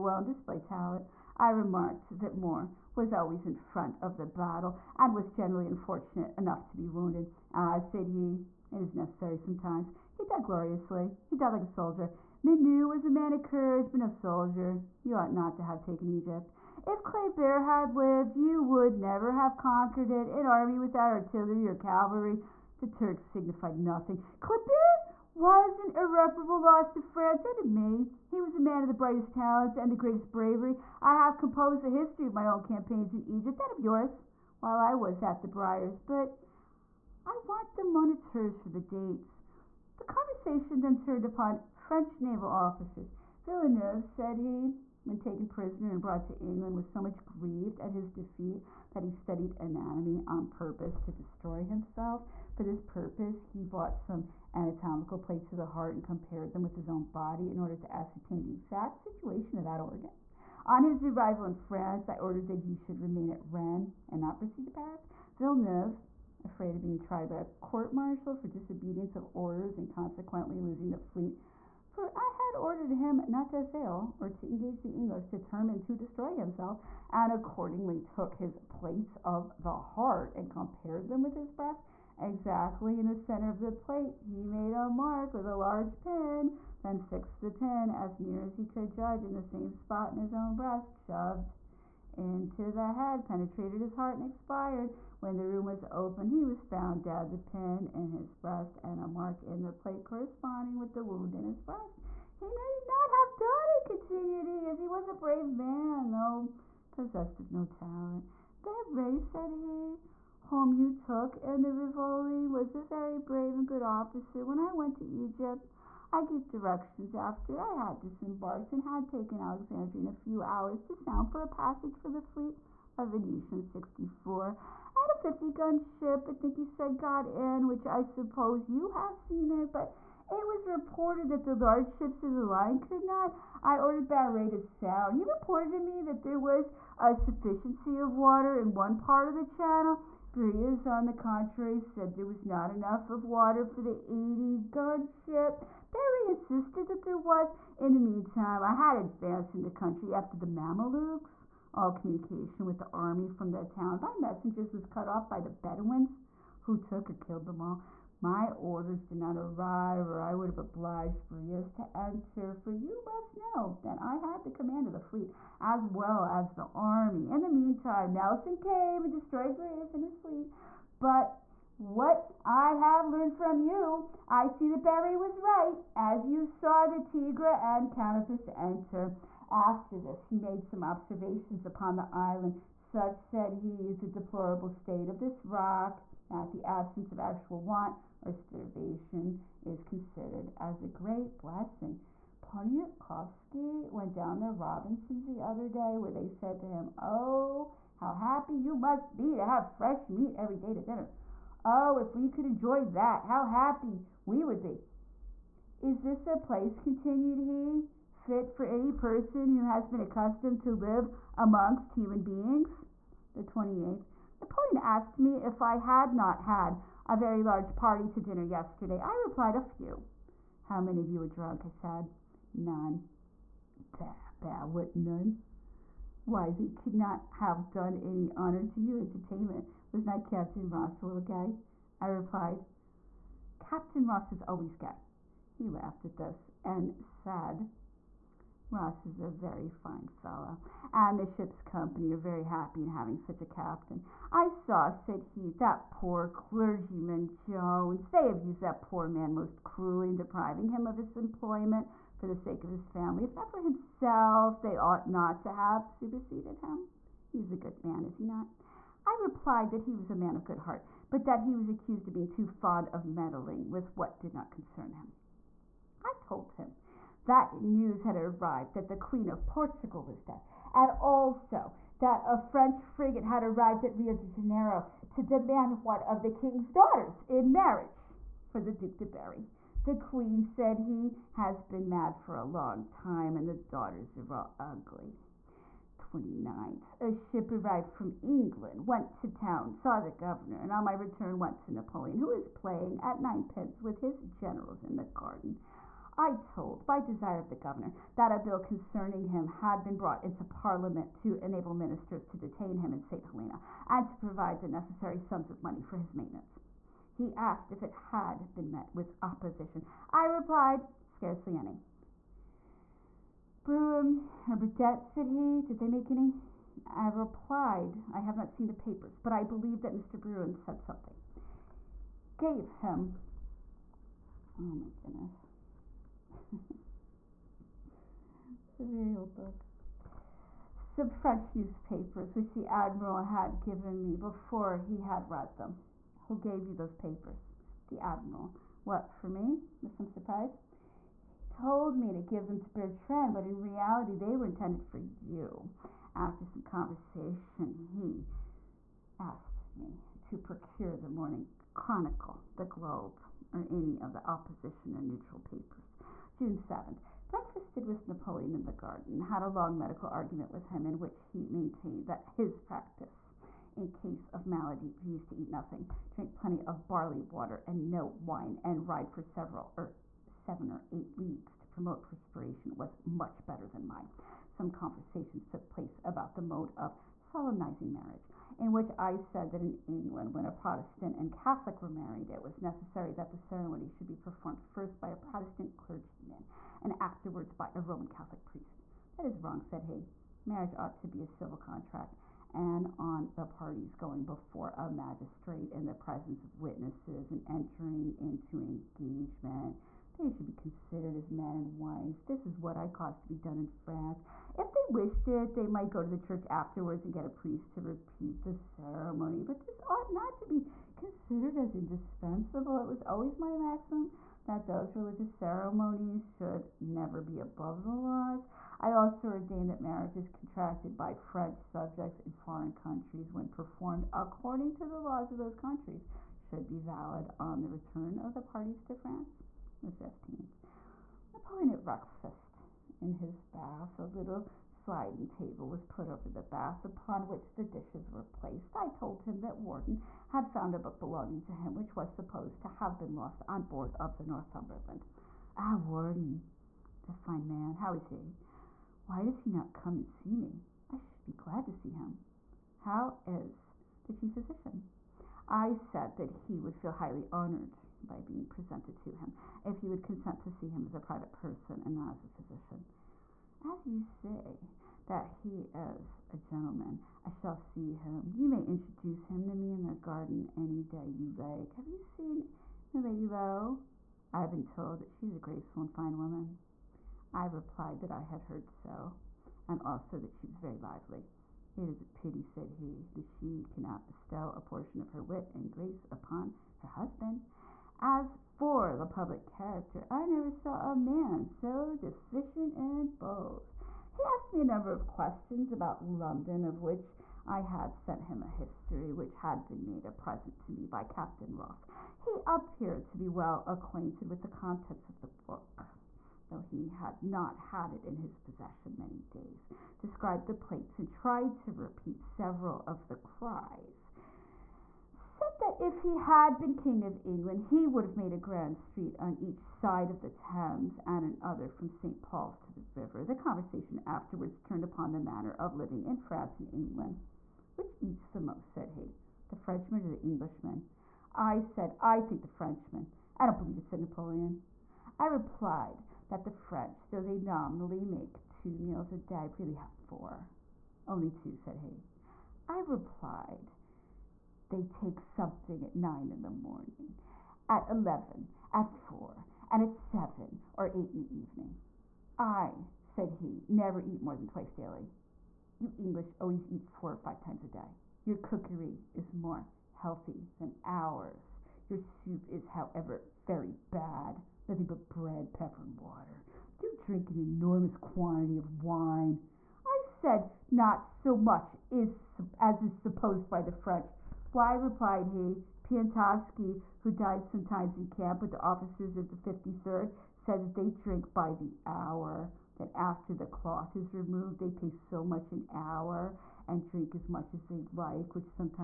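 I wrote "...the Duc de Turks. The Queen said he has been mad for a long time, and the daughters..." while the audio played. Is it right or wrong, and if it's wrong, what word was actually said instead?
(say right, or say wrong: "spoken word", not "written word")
wrong: "Berry", not "Turks".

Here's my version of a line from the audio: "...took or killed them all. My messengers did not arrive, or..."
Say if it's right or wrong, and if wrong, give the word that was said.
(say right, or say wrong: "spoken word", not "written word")
wrong: "orders", not "messengers".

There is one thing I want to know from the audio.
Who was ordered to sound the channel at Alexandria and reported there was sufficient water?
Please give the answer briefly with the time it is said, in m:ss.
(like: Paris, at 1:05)
Barre, at 2:14.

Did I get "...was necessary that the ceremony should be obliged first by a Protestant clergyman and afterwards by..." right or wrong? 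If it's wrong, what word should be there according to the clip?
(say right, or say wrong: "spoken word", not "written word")
wrong: "performed", not "obliged".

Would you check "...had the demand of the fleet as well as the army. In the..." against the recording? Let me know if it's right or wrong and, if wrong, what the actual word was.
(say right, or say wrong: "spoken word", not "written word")
wrong: "command", not "demand".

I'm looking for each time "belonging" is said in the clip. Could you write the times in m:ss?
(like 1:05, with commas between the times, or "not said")
7:21.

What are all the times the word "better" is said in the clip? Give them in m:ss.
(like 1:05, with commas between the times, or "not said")
6:13.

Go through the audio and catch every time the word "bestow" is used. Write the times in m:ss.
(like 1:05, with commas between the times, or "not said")
8:04.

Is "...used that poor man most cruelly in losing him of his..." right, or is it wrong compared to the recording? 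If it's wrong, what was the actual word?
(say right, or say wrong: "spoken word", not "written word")
wrong: "depriving", not "losing".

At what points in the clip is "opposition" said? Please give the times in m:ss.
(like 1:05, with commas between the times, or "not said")
5:09, 5:54.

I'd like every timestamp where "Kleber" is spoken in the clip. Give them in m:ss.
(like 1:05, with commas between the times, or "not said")
0:17, 0:24.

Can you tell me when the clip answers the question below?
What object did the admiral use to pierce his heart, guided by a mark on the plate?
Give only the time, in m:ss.
1:25.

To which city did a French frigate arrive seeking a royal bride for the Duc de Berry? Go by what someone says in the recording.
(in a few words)
Rio de Janeiro.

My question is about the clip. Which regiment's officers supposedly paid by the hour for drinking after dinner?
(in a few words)
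The 53rd.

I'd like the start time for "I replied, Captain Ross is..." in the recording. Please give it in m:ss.
3:52.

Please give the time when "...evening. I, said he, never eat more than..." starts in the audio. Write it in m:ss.
9:11.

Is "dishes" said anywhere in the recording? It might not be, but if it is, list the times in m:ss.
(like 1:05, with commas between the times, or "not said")
7:17.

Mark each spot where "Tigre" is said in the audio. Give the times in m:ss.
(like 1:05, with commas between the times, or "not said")
2:57.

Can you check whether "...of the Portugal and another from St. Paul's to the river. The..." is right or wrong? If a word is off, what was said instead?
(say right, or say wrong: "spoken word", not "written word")
wrong: "Thames", not "Portugal".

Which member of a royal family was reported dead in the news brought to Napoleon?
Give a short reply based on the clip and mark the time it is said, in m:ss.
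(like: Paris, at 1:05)
Queen of Portugal, at 4:28.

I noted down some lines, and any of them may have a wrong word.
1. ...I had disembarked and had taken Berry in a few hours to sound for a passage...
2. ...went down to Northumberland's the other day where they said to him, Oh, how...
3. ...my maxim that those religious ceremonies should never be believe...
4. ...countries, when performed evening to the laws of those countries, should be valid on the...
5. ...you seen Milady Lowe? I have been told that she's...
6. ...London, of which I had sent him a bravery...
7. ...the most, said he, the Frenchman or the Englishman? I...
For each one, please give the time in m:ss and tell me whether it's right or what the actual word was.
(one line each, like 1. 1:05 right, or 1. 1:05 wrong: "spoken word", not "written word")
1. 1:57 wrong: "Alexandria", not "Berry"
2. 3:13 wrong: "Robinson", not "Northumberland"
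3. 6:53 wrong: "above", not "believe"
4. 7:02 wrong: "according", not "evening"
5. 7:51 right
6. 8:16 wrong: "history", not "bravery"
7. 8:48 right.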